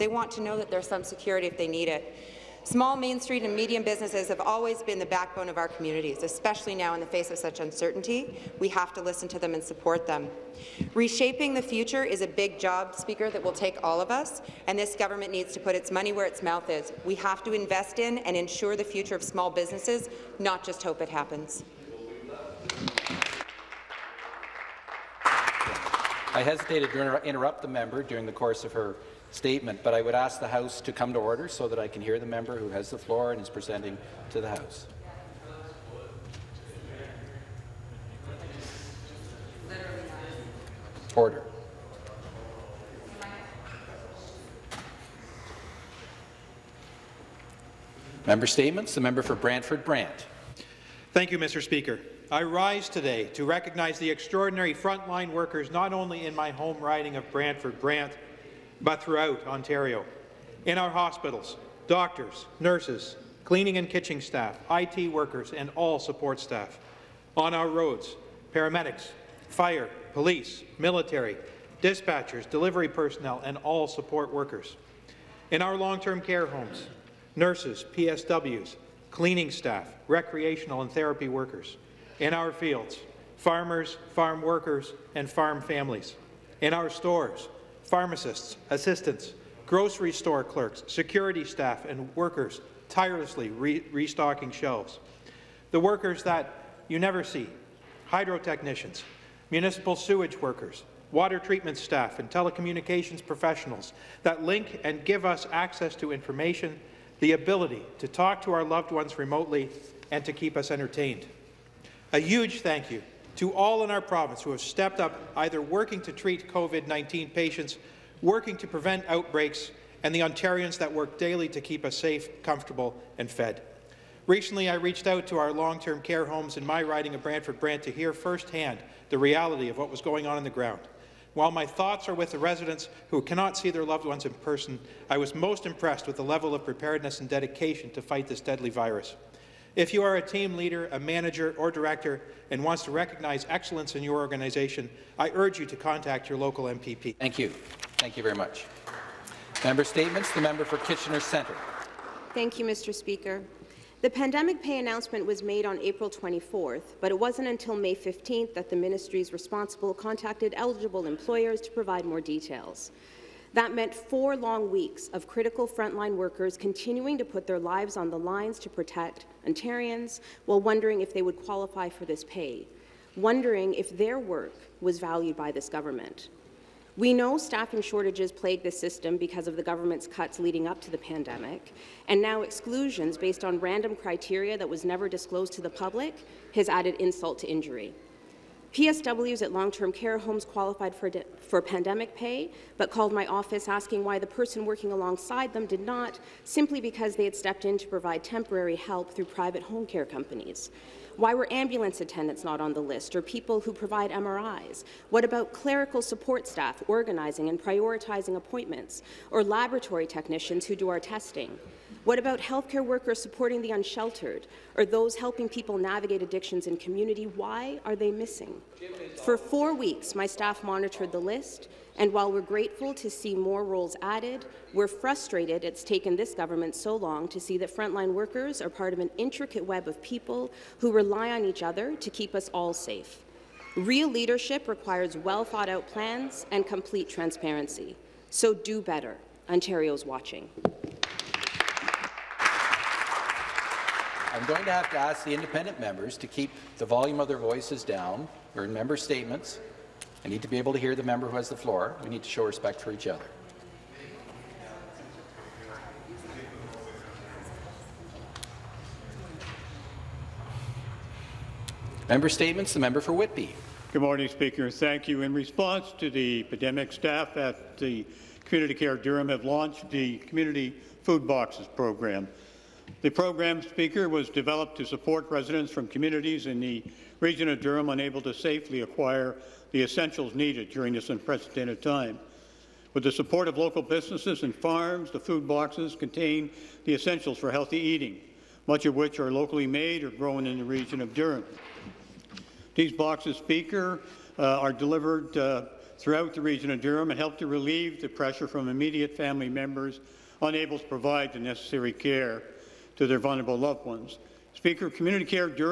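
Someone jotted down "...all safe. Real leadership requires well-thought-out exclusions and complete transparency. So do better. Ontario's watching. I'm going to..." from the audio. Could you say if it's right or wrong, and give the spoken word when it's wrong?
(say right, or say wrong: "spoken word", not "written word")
wrong: "plans", not "exclusions".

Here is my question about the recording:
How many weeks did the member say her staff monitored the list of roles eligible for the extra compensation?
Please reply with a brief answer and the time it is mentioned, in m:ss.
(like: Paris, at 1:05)
4, at 3:39.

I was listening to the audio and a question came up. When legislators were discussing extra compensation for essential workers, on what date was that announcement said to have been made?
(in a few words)
April 24.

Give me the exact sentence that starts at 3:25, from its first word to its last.
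What about clerical support staff organizing and prioritizing appointments, or laboratory technicians who do our testing?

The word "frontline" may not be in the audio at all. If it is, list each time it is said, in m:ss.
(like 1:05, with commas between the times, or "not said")
0:54, 2:45, 3:47.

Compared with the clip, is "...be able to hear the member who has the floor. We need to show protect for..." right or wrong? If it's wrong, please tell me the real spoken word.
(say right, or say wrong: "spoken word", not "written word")
wrong: "respect", not "protect".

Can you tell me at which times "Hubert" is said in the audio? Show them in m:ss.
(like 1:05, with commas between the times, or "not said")
not said.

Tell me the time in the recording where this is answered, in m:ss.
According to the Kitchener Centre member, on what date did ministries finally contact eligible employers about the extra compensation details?
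2:37.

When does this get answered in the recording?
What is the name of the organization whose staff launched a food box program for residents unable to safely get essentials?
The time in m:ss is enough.
4:28.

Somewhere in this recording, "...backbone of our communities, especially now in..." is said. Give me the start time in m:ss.
0:05.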